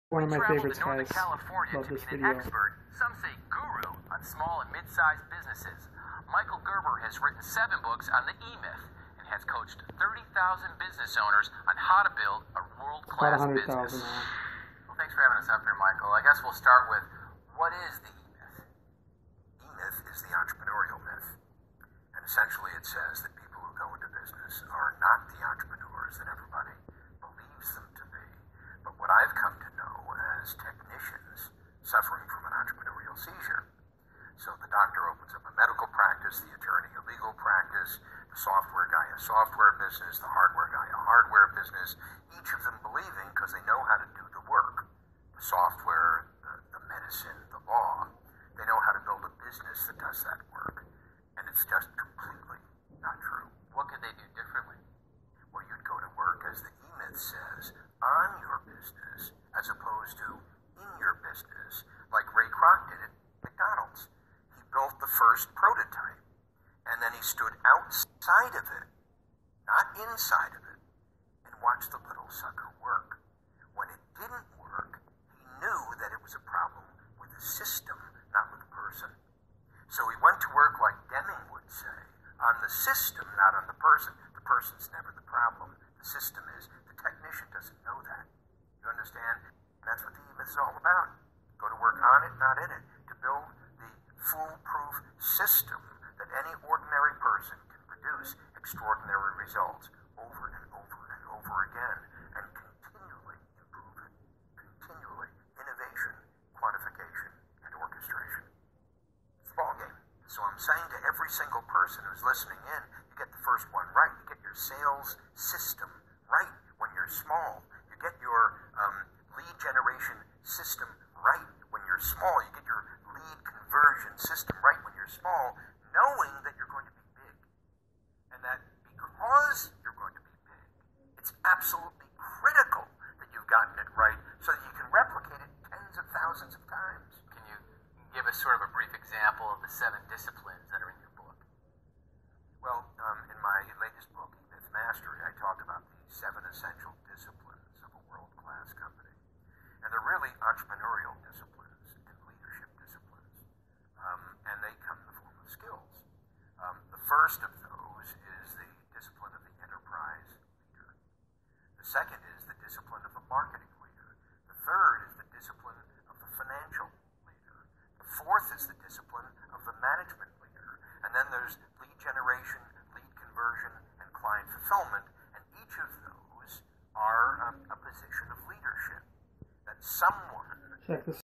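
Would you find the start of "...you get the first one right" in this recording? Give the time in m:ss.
1:53.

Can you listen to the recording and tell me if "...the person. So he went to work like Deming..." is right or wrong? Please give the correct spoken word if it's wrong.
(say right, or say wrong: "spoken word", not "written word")
right.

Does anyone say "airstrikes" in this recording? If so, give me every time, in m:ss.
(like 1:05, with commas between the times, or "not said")
not said.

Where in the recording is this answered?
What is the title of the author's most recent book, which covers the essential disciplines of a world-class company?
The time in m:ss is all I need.
2:24.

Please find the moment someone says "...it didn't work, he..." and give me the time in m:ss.
1:13.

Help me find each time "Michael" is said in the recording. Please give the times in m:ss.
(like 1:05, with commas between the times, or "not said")
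0:06, 0:15.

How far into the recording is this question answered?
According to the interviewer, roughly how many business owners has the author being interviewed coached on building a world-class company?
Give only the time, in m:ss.
0:10.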